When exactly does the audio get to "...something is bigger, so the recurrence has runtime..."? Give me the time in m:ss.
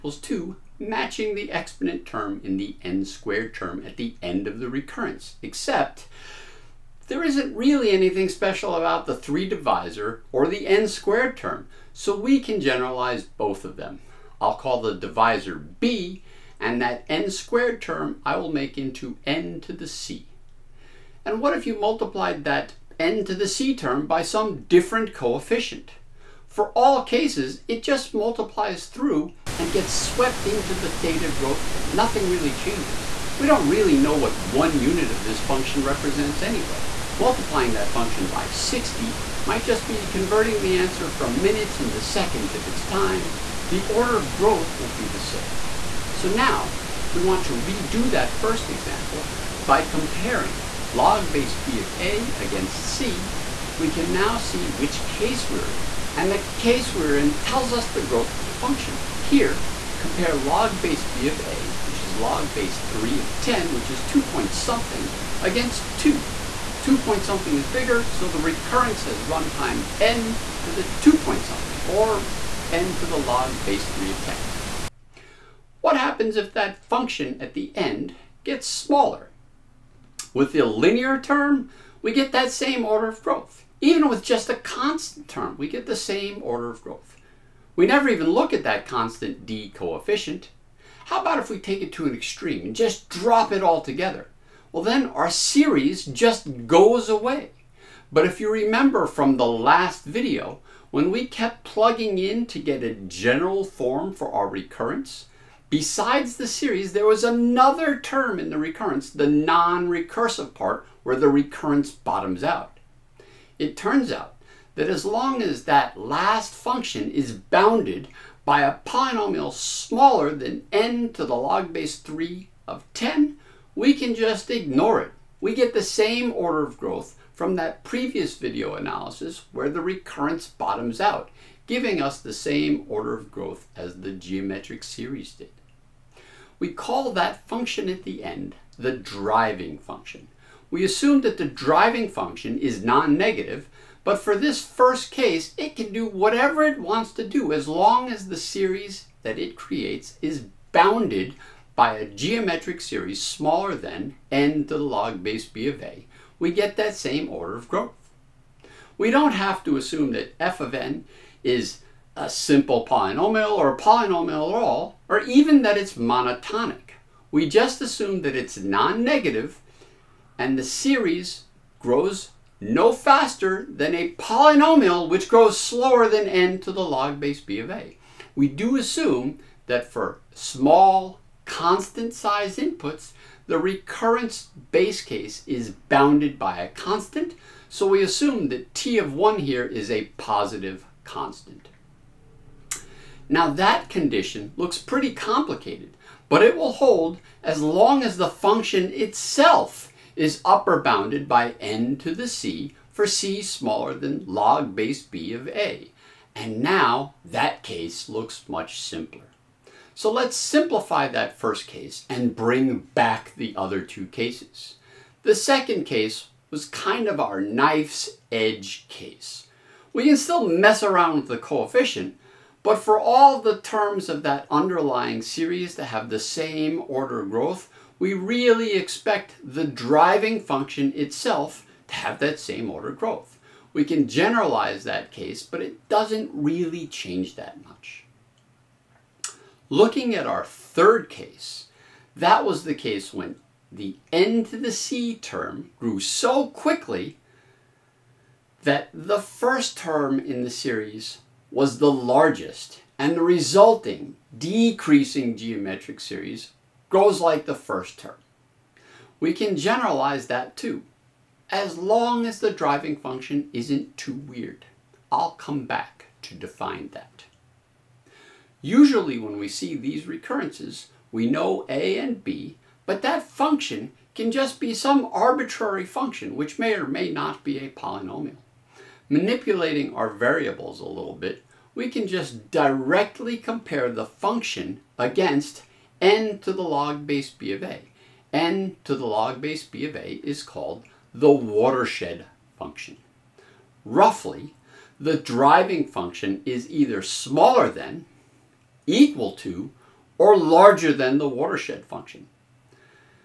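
1:07.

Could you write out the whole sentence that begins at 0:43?
The order of growth will be the same.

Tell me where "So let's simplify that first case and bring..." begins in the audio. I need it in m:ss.
3:29.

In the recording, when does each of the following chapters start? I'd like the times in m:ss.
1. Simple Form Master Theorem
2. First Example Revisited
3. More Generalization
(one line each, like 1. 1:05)
1. 0:24
2. 0:48
3. 1:15.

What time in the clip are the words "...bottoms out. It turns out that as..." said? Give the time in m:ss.
1:51.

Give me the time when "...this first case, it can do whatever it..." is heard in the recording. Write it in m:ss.
2:24.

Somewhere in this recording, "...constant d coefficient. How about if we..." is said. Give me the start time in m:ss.
1:28.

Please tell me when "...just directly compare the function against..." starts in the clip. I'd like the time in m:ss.
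4:42.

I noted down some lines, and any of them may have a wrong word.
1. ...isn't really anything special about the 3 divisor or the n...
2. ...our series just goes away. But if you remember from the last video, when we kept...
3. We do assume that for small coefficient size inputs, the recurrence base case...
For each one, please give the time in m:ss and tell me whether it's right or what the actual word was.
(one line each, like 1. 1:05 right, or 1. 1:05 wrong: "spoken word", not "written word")
1. 0:07 right
2. 1:35 right
3. 2:58 wrong: "constant", not "coefficient".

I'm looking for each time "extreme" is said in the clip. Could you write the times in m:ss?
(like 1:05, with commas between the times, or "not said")
1:32.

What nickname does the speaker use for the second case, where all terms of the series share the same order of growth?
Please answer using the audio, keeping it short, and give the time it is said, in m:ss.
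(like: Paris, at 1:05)
knife's edge case, at 3:37.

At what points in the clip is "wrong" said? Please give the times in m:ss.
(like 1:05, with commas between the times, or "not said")
not said.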